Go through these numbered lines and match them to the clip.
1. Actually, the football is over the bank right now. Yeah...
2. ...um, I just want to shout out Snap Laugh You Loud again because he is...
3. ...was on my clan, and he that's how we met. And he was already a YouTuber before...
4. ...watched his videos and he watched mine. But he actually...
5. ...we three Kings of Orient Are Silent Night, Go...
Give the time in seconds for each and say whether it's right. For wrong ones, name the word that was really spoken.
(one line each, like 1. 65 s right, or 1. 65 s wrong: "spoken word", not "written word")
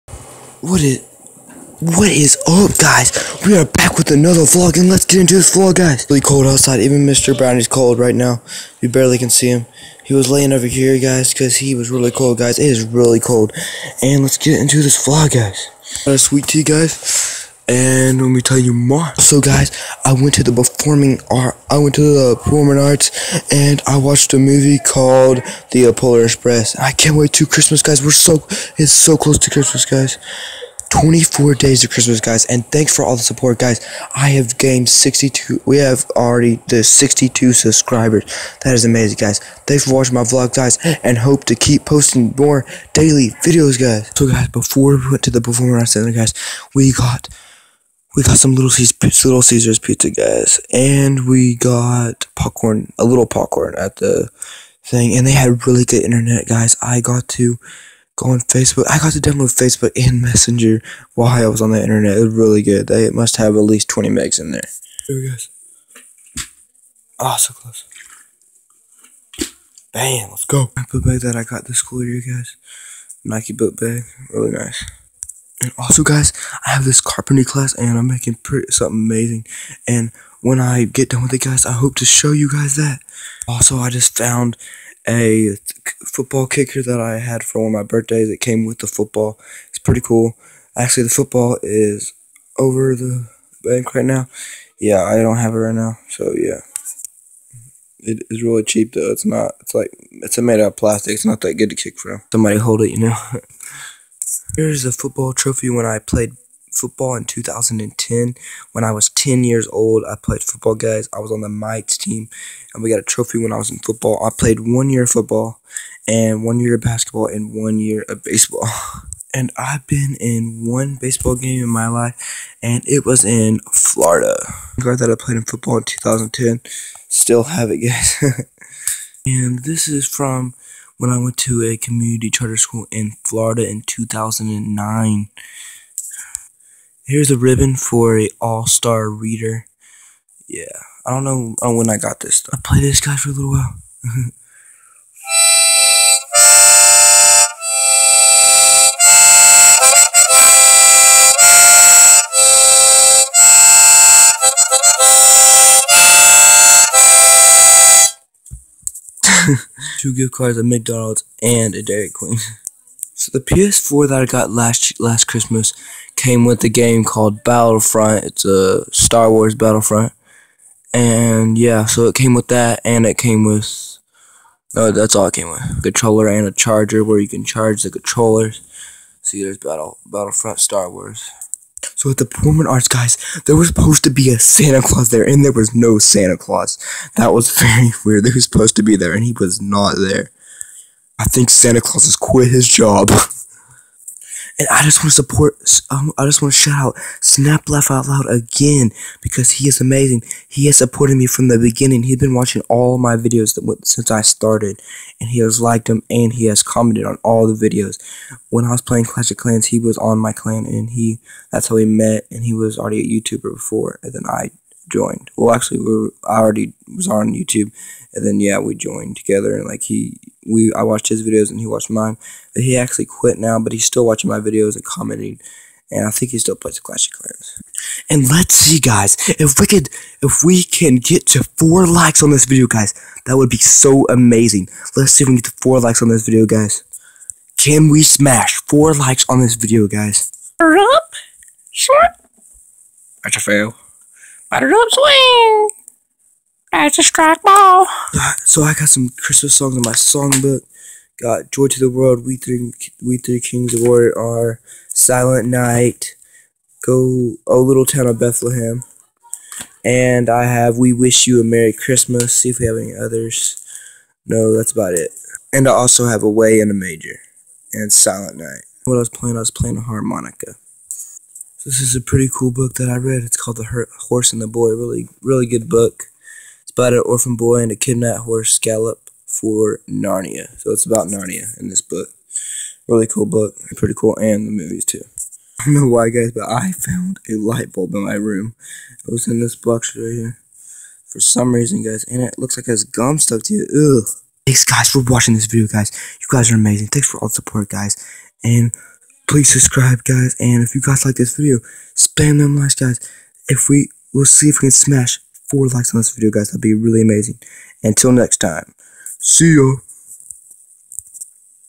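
1. 90 s right
2. 195 s wrong: "Out", not "You"
3. 209 s right
4. 220 s right
5. 253 s right.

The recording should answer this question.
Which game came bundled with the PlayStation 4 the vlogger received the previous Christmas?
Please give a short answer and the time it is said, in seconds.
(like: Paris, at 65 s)
Star Wars Battlefront, at 168 s.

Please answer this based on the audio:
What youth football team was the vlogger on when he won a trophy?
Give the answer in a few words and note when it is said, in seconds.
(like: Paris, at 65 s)
Mites, at 111 s.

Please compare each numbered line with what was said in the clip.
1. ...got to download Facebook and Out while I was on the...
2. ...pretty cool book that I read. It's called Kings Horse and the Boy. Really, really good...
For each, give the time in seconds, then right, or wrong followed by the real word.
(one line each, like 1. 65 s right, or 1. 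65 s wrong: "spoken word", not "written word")
1. 58 s wrong: "Messenger", not "Out"
2. 272 s wrong: "The", not "Kings".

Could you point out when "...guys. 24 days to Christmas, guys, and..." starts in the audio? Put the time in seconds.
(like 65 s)
29 s.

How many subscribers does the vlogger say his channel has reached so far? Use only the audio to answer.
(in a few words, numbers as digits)
62.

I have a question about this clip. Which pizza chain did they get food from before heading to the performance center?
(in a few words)
Little Caesars.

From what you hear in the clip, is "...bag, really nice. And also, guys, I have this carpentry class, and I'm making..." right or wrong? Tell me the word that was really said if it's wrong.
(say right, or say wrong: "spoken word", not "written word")
right.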